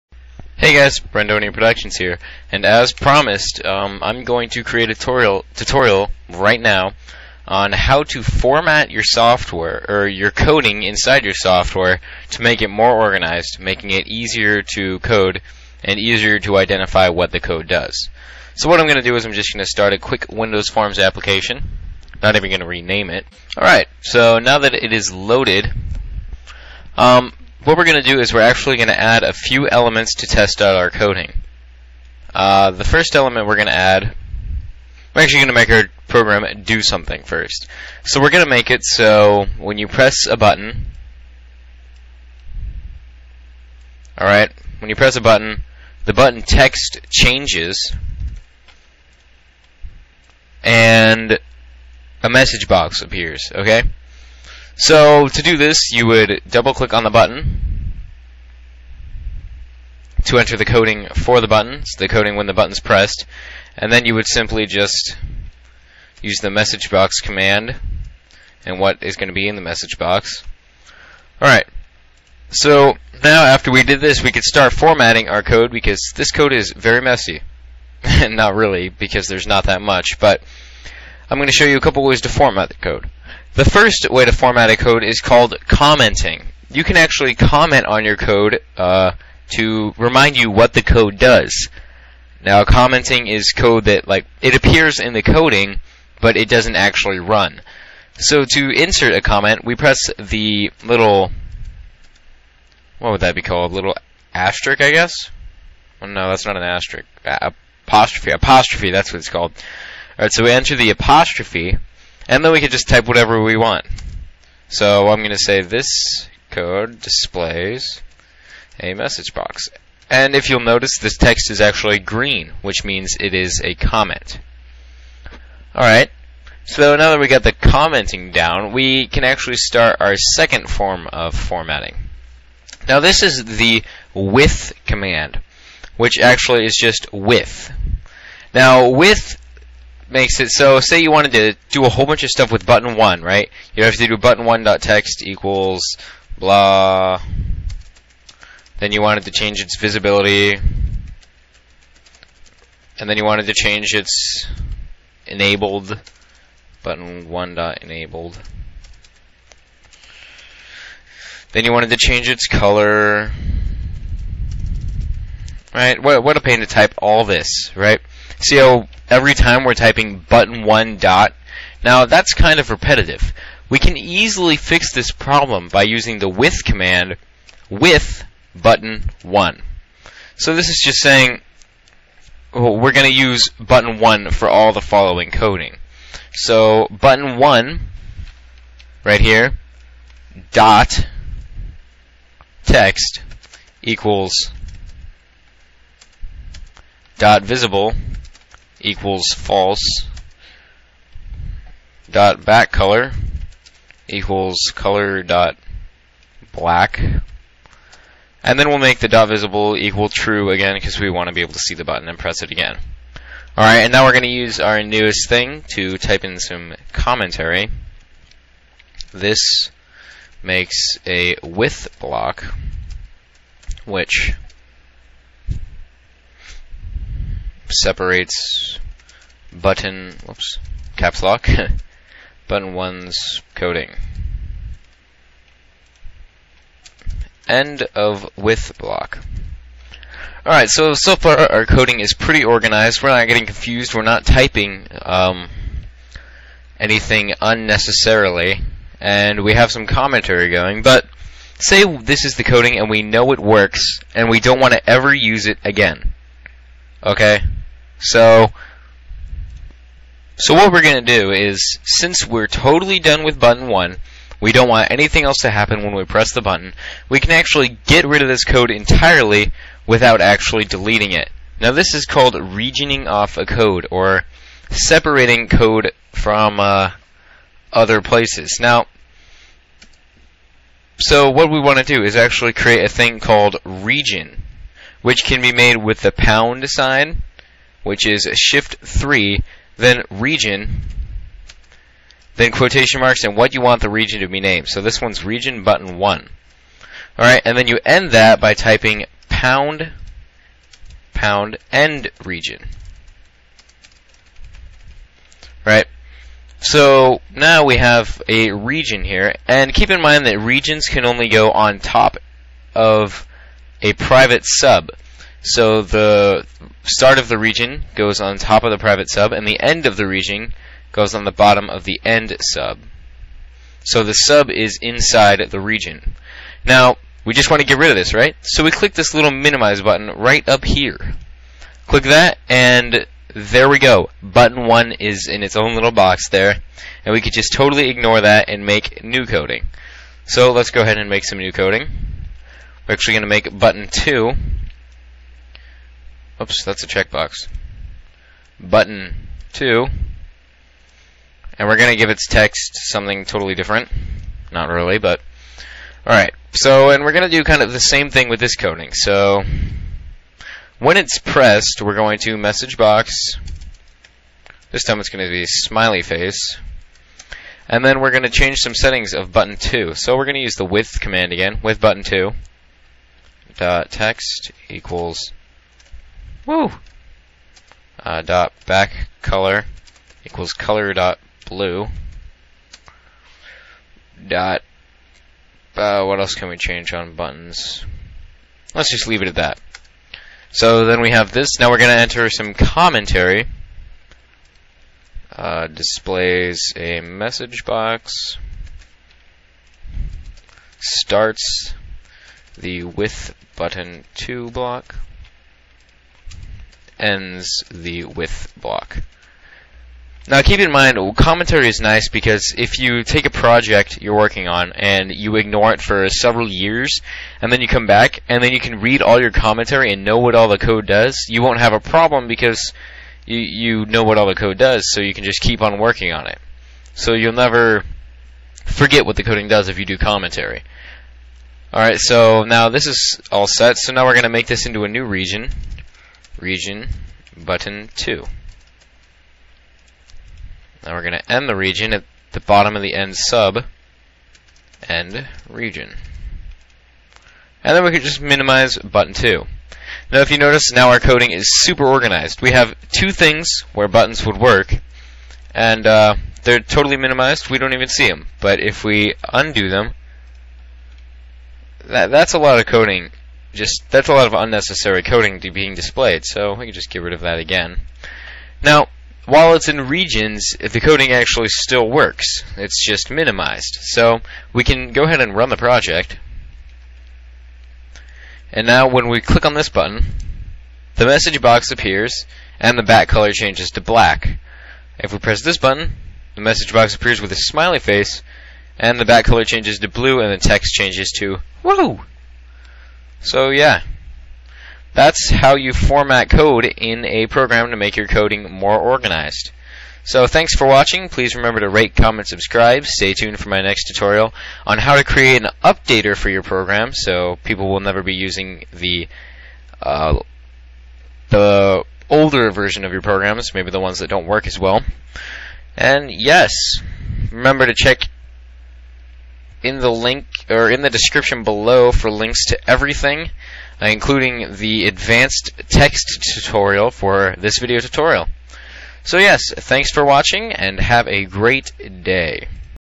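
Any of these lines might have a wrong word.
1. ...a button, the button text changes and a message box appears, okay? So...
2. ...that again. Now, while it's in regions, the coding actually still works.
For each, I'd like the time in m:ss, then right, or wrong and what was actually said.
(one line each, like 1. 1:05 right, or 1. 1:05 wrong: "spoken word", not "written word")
1. 0:45 right
2. 7:47 right.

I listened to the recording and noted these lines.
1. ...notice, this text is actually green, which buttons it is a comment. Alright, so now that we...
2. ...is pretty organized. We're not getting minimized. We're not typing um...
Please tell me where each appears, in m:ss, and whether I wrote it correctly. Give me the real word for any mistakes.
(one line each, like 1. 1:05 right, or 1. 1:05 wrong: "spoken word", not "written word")
1. 2:00 wrong: "means", not "buttons"
2. 4:01 wrong: "confused", not "minimized".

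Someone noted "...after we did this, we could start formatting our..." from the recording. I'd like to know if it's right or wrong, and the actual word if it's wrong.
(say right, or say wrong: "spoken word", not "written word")
right.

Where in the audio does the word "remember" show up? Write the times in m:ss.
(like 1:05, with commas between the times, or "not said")
8:21, 8:37.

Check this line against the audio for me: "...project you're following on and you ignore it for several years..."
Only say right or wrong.
wrong.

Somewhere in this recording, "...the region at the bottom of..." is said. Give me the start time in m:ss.
7:21.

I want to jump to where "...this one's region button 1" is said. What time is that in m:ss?
4:54.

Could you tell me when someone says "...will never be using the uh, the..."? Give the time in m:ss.
8:27.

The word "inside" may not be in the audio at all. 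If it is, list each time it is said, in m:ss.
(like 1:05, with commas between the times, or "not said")
0:10, 5:24.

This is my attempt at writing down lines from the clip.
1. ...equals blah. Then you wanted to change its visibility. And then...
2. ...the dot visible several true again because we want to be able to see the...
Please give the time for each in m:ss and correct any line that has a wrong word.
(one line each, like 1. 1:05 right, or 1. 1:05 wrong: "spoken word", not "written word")
1. 2:25 right
2. 3:28 wrong: "equal", not "several".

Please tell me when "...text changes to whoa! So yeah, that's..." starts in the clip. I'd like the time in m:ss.
8:10.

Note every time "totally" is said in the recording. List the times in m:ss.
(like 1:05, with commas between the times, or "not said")
4:22, 5:37, 5:53, 7:36.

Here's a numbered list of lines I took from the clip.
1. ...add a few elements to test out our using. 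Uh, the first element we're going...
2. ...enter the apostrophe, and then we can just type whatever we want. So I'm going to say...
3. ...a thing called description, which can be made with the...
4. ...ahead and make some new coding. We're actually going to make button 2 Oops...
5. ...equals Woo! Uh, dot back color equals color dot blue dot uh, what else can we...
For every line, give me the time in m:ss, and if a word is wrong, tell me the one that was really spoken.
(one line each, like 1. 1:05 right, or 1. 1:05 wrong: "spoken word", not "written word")
1. 0:28 wrong: "coding", not "using"
2. 1:50 right
3. 4:42 wrong: "region", not "description"
4. 5:40 right
5. 6:14 right.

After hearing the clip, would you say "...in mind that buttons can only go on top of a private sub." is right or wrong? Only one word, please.
wrong.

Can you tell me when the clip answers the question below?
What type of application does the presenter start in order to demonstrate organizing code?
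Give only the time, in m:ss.
0:20.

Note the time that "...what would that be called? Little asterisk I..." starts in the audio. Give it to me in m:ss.
1:42.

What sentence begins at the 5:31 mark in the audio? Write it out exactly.
Click that, and there we go.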